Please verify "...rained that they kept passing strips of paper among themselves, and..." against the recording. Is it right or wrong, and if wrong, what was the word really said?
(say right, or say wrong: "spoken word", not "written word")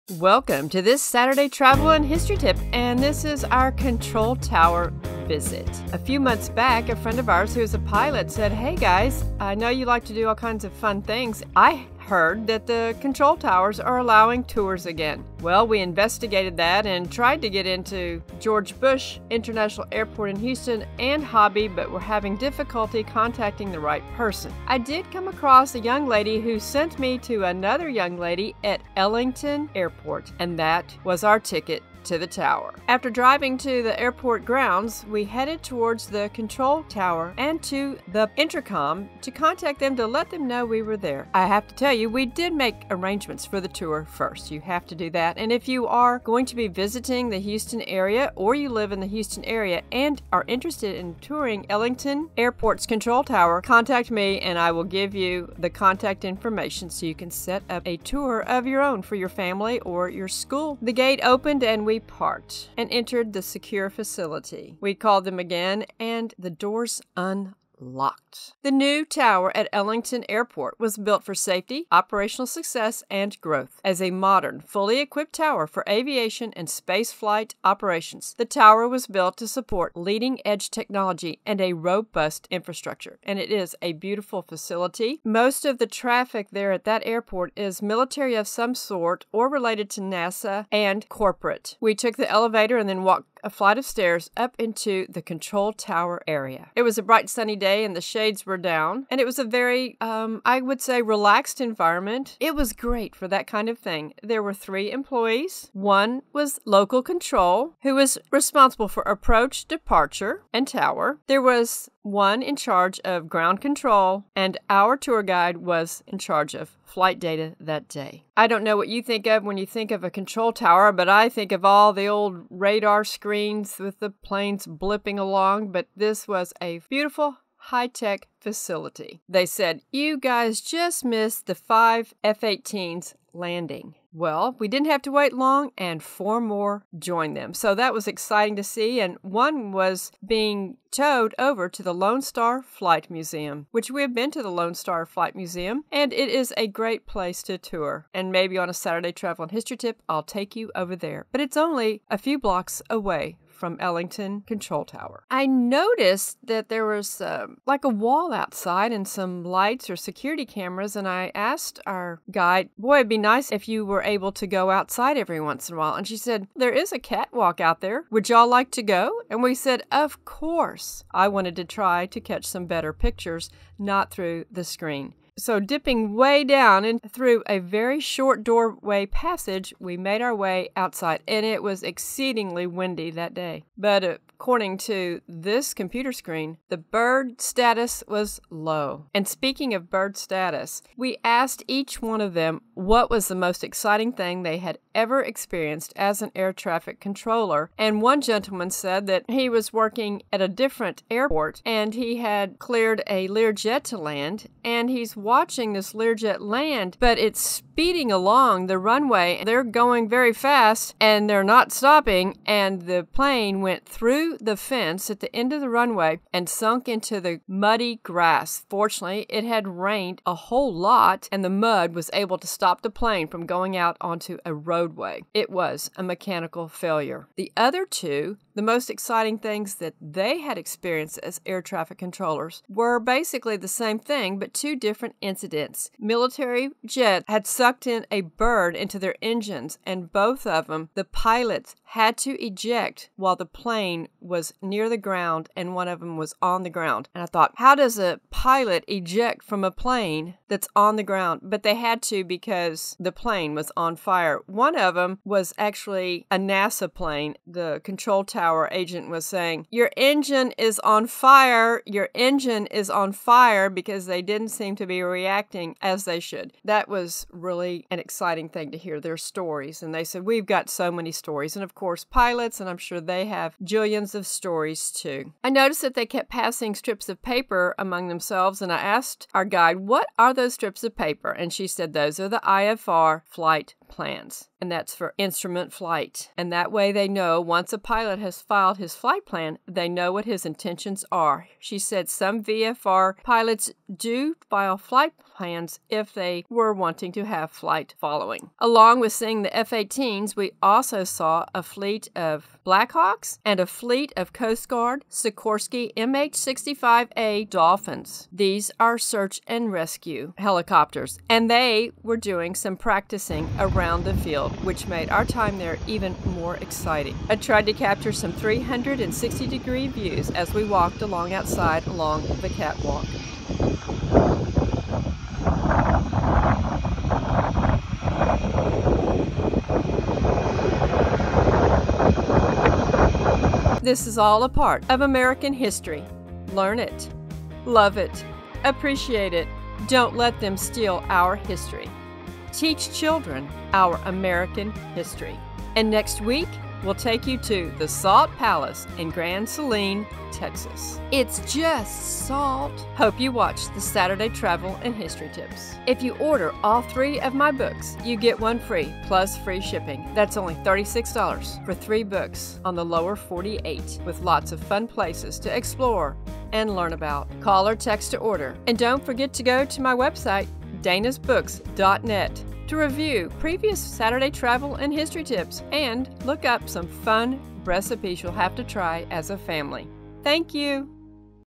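wrong: "noticed", not "rained".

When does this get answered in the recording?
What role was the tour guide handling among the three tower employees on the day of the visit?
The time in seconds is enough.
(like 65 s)
116 s.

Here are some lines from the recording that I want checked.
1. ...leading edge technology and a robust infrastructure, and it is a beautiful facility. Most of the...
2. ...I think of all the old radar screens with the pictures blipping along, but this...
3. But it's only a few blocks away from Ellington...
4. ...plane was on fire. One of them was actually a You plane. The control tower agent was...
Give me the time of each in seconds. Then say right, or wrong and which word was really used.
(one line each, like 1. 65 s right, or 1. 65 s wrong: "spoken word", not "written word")
1. 79 s right
2. 121 s wrong: "planes", not "pictures"
3. 151 s right
4. 253 s wrong: "NASA", not "You".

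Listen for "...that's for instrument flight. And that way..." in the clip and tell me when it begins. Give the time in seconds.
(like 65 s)
284 s.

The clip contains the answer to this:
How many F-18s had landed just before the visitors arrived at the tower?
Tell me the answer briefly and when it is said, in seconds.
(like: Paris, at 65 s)
5, at 131 s.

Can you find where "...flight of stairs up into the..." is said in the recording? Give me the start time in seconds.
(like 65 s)
93 s.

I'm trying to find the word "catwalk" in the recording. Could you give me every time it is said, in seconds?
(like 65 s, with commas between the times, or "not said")
166 s, 322 s.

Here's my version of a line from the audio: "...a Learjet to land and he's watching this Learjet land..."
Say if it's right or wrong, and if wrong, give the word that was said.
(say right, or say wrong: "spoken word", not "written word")
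right.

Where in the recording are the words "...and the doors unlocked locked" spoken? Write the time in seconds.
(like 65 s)
65 s.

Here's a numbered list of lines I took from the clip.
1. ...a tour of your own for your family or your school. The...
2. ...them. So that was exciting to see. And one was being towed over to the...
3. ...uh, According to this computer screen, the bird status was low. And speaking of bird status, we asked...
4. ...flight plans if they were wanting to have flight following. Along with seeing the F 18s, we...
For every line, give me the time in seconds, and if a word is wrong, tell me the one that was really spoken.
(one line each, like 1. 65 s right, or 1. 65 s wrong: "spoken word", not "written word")
1. 57 s right
2. 137 s right
3. 184 s right
4. 294 s right.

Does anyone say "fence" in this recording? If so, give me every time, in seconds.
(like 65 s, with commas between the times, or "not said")
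214 s.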